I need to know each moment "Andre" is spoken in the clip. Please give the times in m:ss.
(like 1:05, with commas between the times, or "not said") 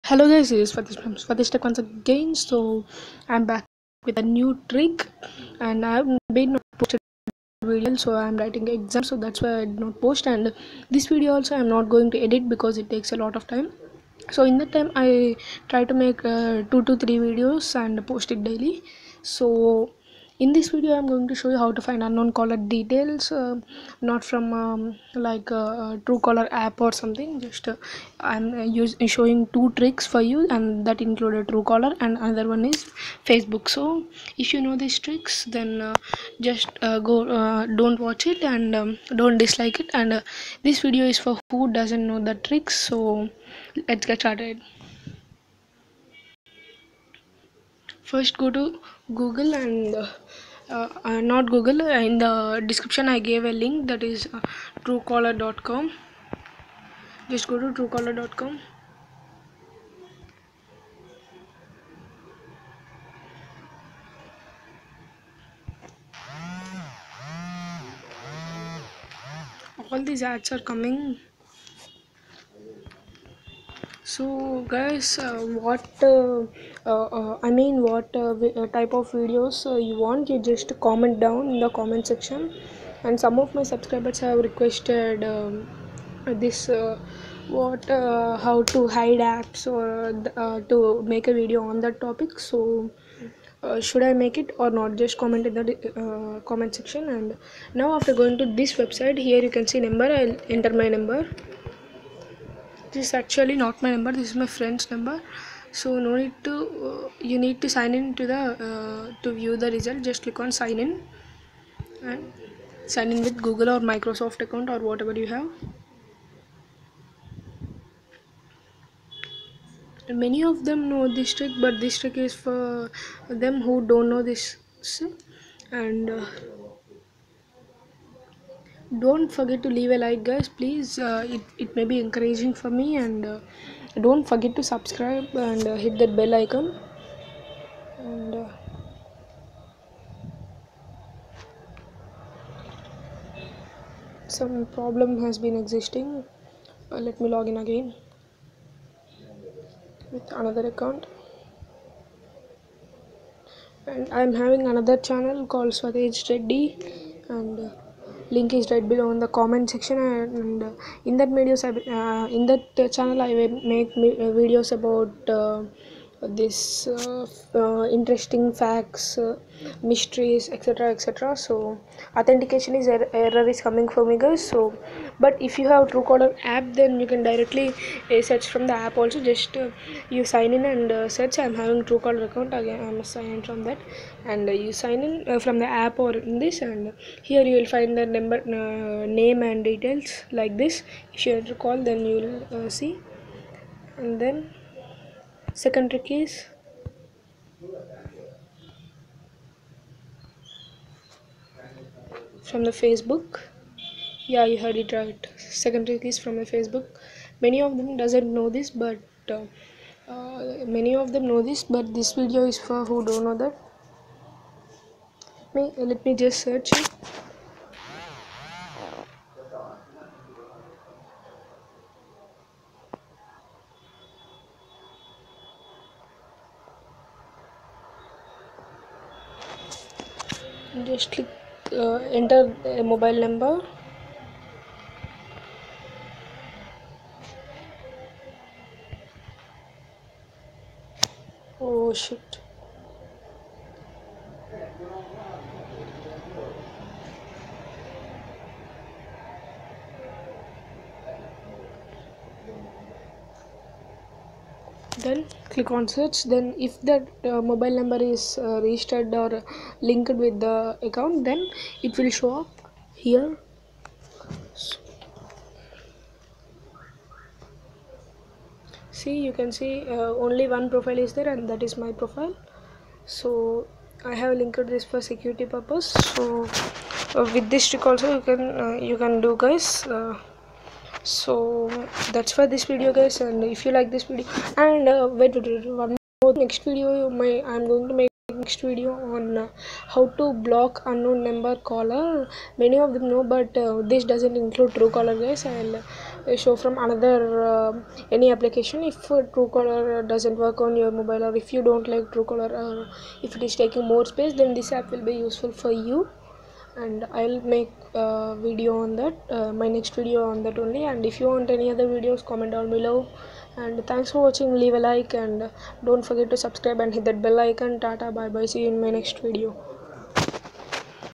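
not said.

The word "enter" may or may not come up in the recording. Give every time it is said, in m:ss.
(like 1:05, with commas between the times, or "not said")
1:40, 3:52.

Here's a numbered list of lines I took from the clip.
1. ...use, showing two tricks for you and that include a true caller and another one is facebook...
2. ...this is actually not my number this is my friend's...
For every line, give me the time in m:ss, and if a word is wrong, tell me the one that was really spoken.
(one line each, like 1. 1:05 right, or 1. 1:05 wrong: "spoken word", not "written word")
1. 0:28 right
2. 1:42 right.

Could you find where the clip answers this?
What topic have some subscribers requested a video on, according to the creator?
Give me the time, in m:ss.
1:27.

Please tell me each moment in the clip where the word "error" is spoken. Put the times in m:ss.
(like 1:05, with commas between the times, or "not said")
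2:53.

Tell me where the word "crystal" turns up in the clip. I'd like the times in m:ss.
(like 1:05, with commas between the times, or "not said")
not said.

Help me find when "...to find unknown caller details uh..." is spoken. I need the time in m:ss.
0:21.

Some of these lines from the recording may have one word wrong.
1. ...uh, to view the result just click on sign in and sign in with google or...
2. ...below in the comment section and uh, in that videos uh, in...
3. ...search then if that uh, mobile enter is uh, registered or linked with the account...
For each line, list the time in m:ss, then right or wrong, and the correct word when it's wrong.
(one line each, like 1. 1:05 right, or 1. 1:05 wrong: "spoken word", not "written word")
1. 1:48 right
2. 2:38 right
3. 4:15 wrong: "number", not "enter".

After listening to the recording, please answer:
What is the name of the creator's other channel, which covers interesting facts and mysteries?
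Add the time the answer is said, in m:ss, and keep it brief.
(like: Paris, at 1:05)
Swadesh Reddy, at 2:35.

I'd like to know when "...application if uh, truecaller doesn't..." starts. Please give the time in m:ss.
4:58.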